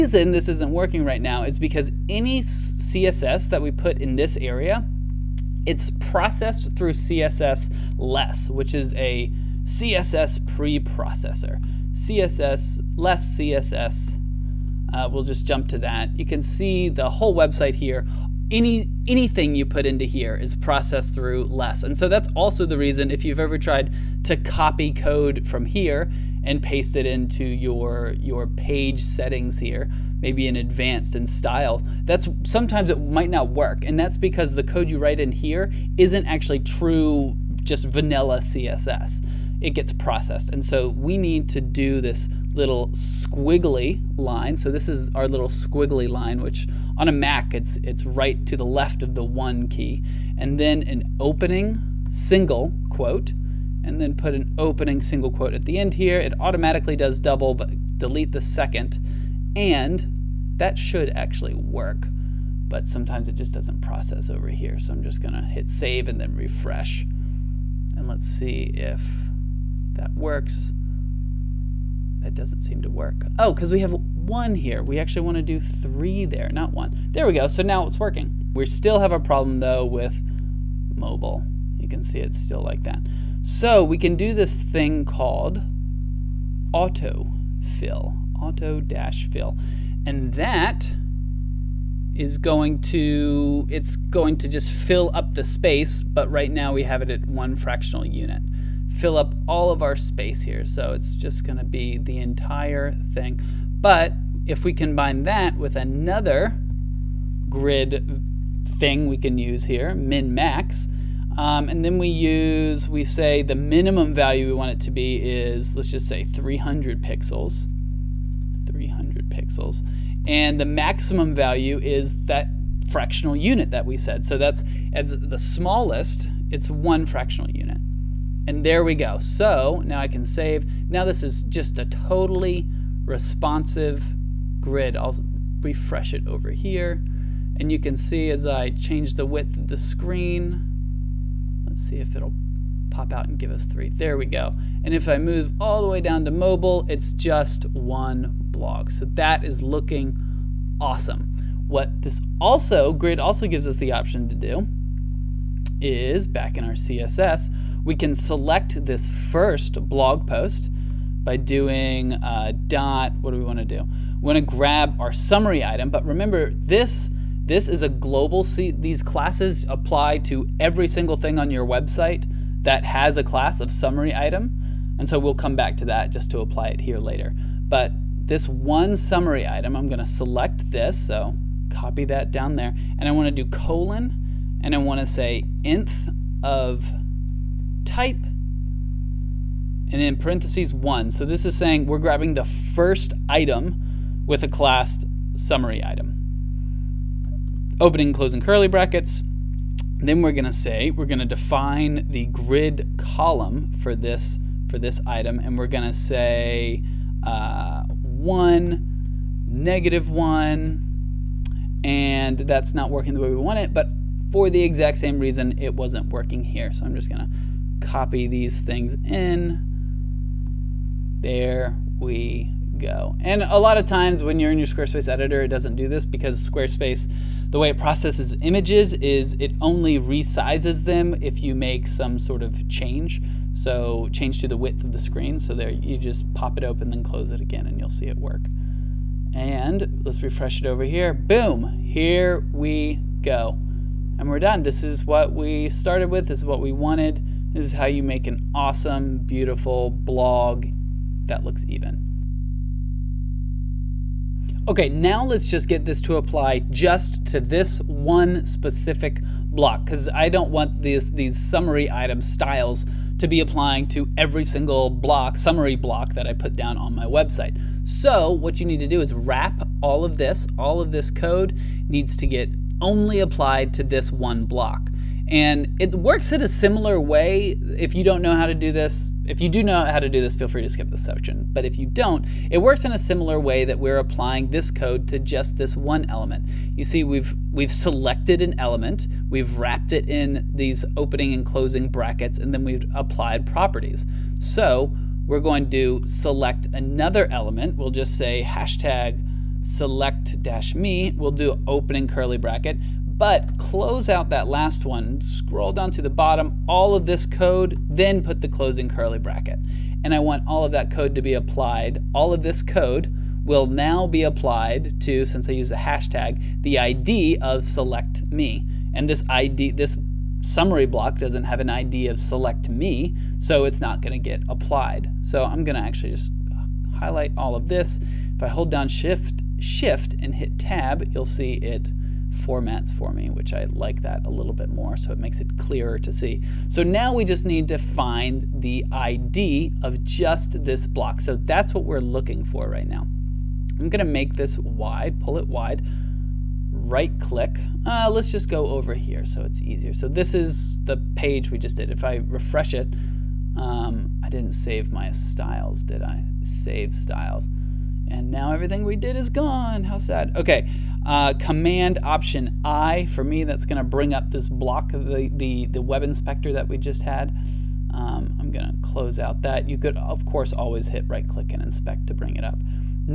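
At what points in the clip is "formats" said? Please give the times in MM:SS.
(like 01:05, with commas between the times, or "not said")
05:32.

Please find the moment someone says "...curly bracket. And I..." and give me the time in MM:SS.
05:08.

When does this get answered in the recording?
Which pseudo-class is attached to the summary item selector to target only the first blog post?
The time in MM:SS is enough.
03:05.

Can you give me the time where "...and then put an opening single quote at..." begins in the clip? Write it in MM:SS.
00:53.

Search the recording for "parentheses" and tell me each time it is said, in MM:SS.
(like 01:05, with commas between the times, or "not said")
03:10.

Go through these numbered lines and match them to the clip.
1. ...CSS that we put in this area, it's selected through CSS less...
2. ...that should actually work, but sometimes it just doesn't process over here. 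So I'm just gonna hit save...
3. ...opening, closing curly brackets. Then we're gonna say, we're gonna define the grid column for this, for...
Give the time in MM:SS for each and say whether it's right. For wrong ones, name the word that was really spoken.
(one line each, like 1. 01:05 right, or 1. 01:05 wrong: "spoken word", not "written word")
1. 00:02 wrong: "processed", not "selected"
2. 01:00 right
3. 03:17 right.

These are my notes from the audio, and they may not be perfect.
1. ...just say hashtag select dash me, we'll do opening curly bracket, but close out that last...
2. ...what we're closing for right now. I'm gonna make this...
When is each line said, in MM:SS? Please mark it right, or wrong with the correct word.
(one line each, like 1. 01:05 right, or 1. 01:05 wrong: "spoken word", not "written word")
1. 04:57 right
2. 05:41 wrong: "looking", not "closing".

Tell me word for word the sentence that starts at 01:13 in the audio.
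Oh, because we have one here.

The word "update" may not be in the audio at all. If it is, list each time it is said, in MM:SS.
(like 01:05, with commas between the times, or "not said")
not said.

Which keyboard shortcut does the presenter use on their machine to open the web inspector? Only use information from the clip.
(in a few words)
Command Option I.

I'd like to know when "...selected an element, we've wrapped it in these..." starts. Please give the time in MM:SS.
04:47.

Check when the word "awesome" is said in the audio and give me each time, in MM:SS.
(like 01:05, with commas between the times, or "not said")
02:30, 04:08.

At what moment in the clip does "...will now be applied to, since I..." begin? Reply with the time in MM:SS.
05:13.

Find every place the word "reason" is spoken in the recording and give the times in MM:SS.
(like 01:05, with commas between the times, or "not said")
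00:22, 03:35.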